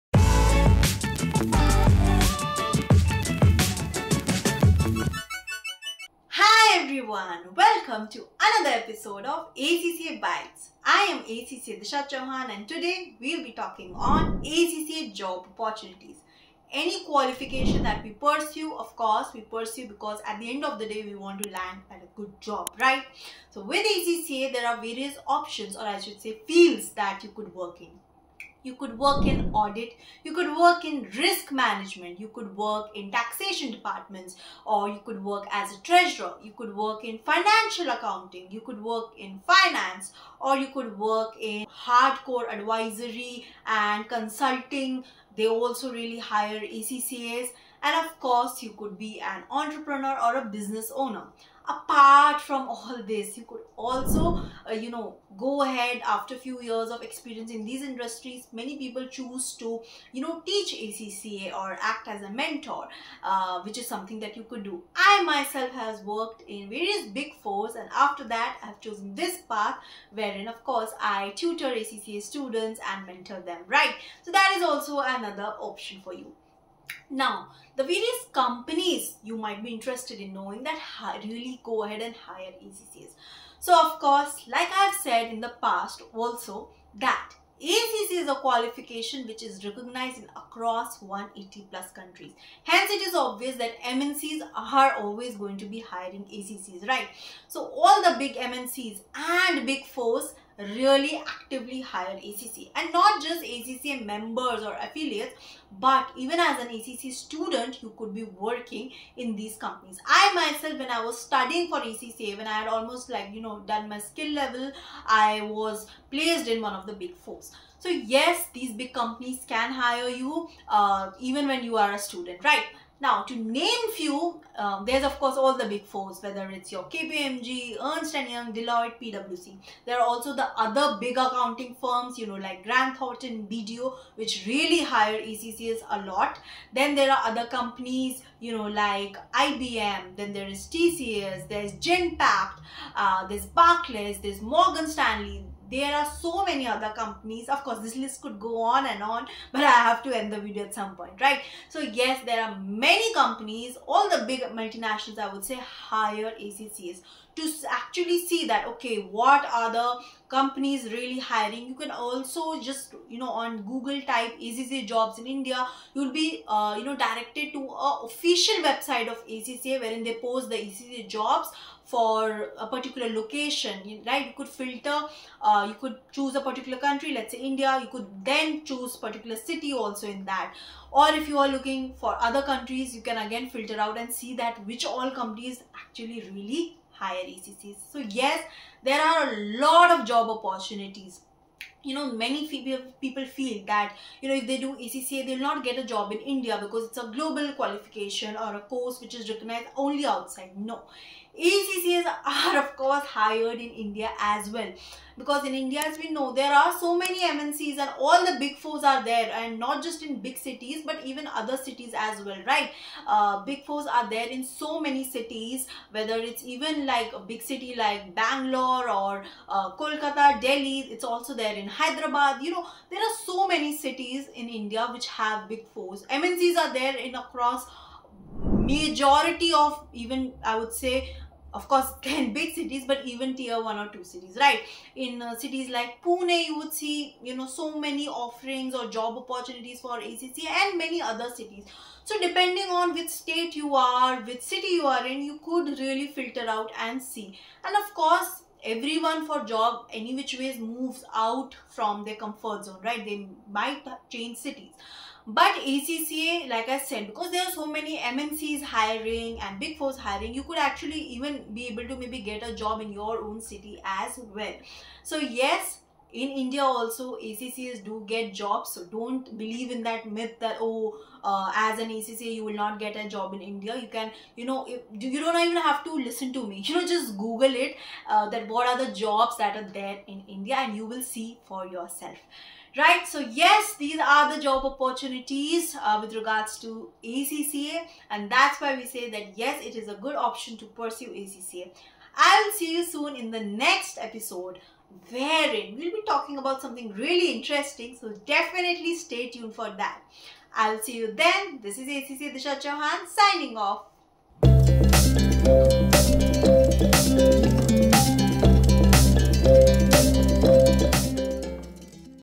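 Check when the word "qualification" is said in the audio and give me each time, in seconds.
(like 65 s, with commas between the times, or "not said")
17 s, 88 s, 197 s.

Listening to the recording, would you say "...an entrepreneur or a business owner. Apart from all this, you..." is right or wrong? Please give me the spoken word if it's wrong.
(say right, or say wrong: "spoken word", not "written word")
right.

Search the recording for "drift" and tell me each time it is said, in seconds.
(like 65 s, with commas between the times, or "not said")
not said.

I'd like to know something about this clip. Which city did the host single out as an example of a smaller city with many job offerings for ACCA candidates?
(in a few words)
Pune.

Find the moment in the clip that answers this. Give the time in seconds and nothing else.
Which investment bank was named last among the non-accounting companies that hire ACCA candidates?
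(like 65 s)
144 s.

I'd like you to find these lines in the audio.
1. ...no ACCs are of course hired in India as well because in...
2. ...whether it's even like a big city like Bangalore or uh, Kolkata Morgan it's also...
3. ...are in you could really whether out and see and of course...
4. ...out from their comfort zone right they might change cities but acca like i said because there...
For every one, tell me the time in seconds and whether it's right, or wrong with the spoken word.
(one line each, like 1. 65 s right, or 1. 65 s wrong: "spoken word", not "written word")
1. 200 s right
2. 215 s wrong: "Delhi", not "Morgan"
3. 244 s wrong: "filter", not "whether"
4. 251 s right.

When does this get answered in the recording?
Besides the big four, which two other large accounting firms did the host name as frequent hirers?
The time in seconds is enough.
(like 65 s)
132 s.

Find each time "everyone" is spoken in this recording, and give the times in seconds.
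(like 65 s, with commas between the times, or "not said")
7 s, 248 s.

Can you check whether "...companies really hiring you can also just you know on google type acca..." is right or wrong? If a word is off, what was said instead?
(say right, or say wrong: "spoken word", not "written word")
right.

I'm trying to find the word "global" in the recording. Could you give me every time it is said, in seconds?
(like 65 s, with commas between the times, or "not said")
197 s.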